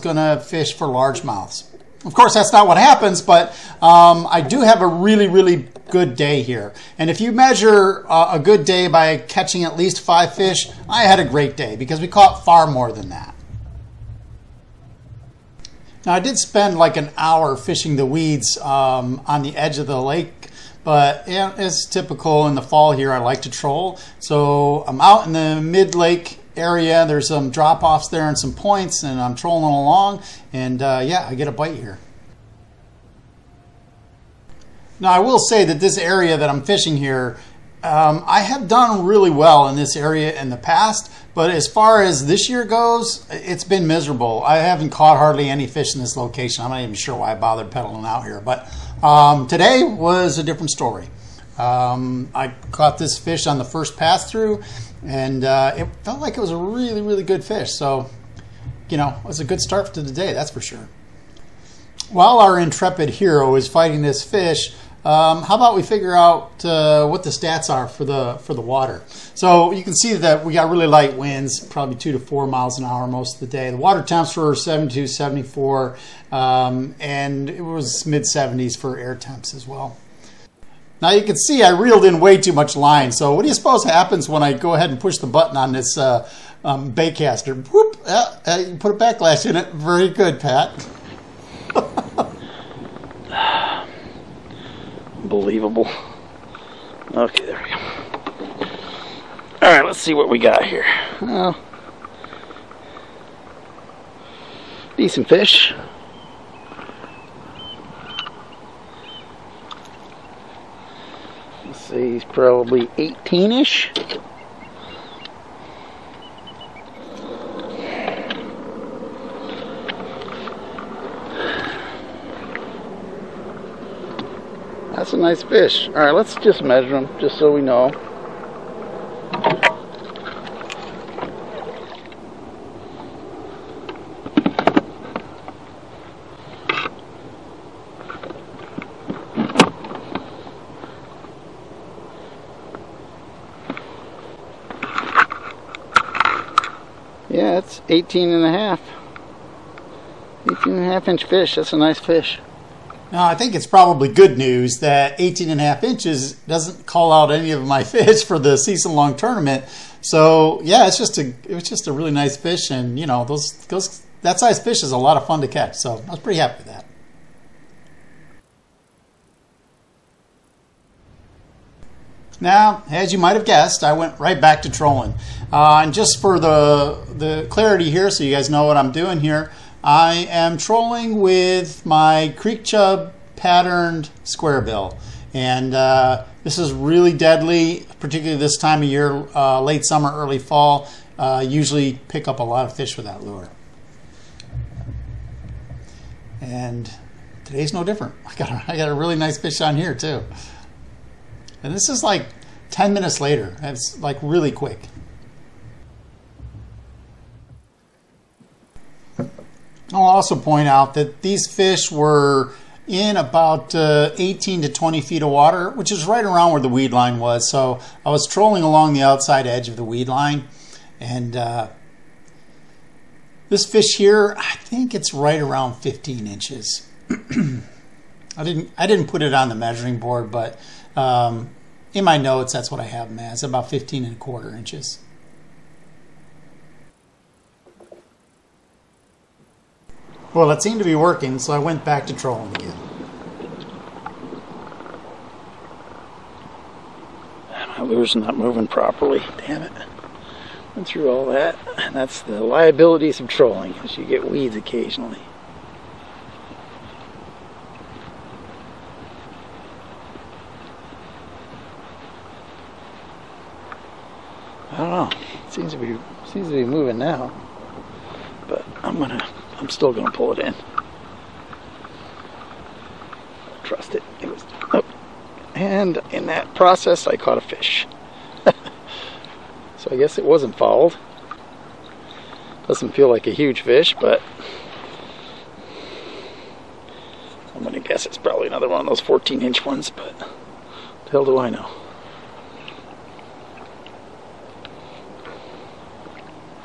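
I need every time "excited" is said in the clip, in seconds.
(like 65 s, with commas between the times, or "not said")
not said.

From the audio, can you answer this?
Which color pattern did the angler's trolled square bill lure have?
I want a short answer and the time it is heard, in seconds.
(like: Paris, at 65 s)
creek chub, at 182 s.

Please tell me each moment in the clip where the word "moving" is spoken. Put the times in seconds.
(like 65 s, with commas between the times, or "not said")
248 s, 266 s.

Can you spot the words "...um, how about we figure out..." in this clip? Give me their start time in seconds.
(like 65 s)
65 s.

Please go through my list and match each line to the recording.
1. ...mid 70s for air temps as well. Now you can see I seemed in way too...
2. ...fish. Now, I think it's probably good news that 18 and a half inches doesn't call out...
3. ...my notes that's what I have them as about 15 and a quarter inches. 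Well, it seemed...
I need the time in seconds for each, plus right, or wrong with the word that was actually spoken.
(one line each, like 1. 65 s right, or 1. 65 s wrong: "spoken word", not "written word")
1. 78 s wrong: "reeled", not "seemed"
2. 151 s right
3. 232 s right.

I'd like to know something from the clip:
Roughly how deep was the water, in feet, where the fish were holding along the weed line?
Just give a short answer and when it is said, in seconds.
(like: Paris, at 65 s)
18 to 20, at 214 s.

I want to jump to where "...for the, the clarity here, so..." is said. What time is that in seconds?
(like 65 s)
176 s.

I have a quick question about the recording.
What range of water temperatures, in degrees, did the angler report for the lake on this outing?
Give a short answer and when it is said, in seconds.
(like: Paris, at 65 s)
72, 74, at 74 s.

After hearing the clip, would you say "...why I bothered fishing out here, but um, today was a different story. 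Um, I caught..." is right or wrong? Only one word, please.
wrong.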